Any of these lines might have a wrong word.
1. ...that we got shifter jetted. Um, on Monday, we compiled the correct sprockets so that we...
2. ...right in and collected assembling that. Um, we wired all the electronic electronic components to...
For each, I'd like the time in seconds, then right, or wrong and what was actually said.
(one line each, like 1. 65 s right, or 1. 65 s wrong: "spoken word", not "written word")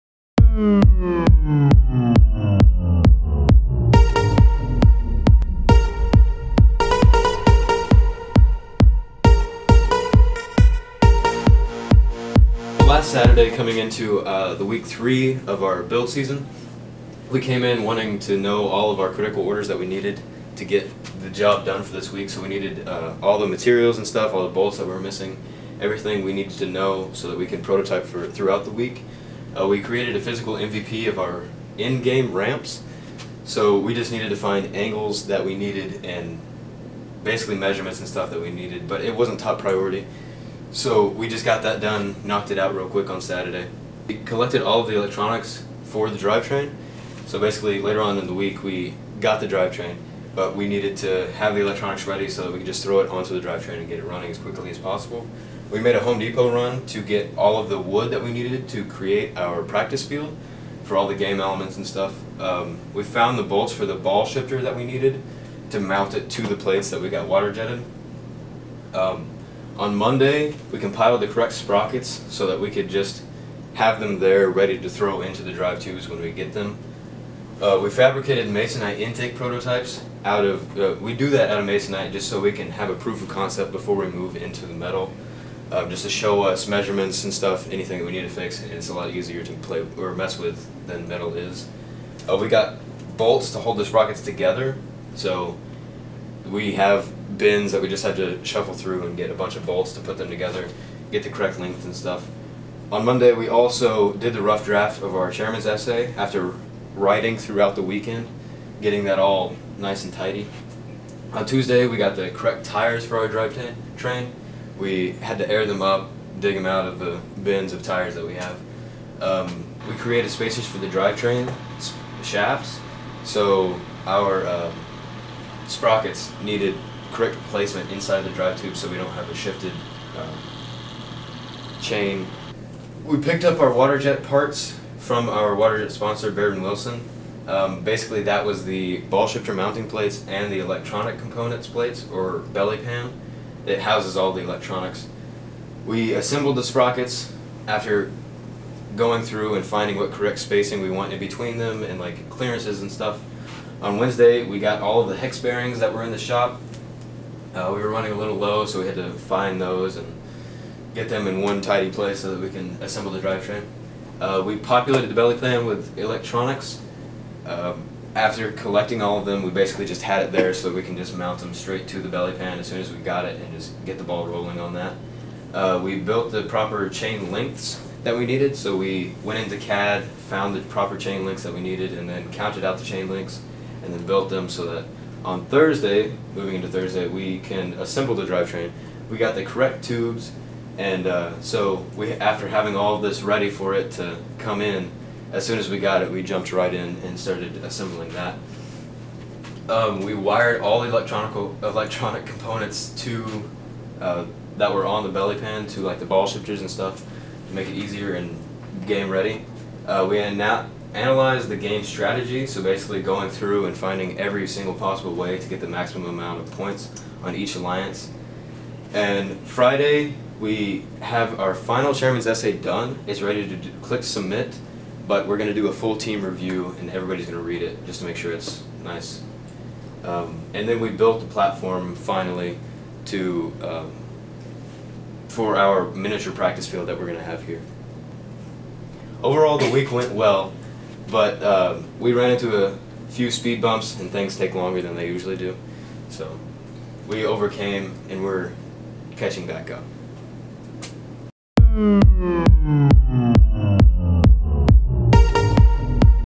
1. 66 s wrong: "water", not "shifter"
2. 196 s wrong: "started", not "collected".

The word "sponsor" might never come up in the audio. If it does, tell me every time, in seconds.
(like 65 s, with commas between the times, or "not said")
135 s.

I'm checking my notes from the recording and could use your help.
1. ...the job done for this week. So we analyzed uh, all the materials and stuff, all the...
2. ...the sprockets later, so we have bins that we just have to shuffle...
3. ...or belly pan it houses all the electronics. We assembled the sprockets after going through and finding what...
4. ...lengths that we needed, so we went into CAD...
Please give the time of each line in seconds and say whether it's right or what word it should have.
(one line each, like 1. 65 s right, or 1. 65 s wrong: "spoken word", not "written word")
1. 21 s wrong: "needed", not "analyzed"
2. 93 s wrong: "together", not "later"
3. 142 s right
4. 177 s right.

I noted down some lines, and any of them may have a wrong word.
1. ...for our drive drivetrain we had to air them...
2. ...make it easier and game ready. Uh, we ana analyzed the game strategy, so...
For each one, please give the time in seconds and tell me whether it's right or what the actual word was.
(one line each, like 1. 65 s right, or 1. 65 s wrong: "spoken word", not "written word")
1. 113 s wrong: "train", not "drivetrain"
2. 207 s right.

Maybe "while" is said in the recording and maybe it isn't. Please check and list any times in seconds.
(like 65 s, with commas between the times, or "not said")
not said.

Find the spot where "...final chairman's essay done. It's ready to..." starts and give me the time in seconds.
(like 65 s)
221 s.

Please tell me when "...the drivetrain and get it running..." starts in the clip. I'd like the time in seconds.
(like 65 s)
53 s.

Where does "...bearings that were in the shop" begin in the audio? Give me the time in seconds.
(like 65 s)
155 s.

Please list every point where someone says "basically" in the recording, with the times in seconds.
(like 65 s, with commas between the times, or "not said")
37 s, 47 s, 137 s, 169 s, 212 s.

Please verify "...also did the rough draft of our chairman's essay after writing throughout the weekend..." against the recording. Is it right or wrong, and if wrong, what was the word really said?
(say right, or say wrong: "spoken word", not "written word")
right.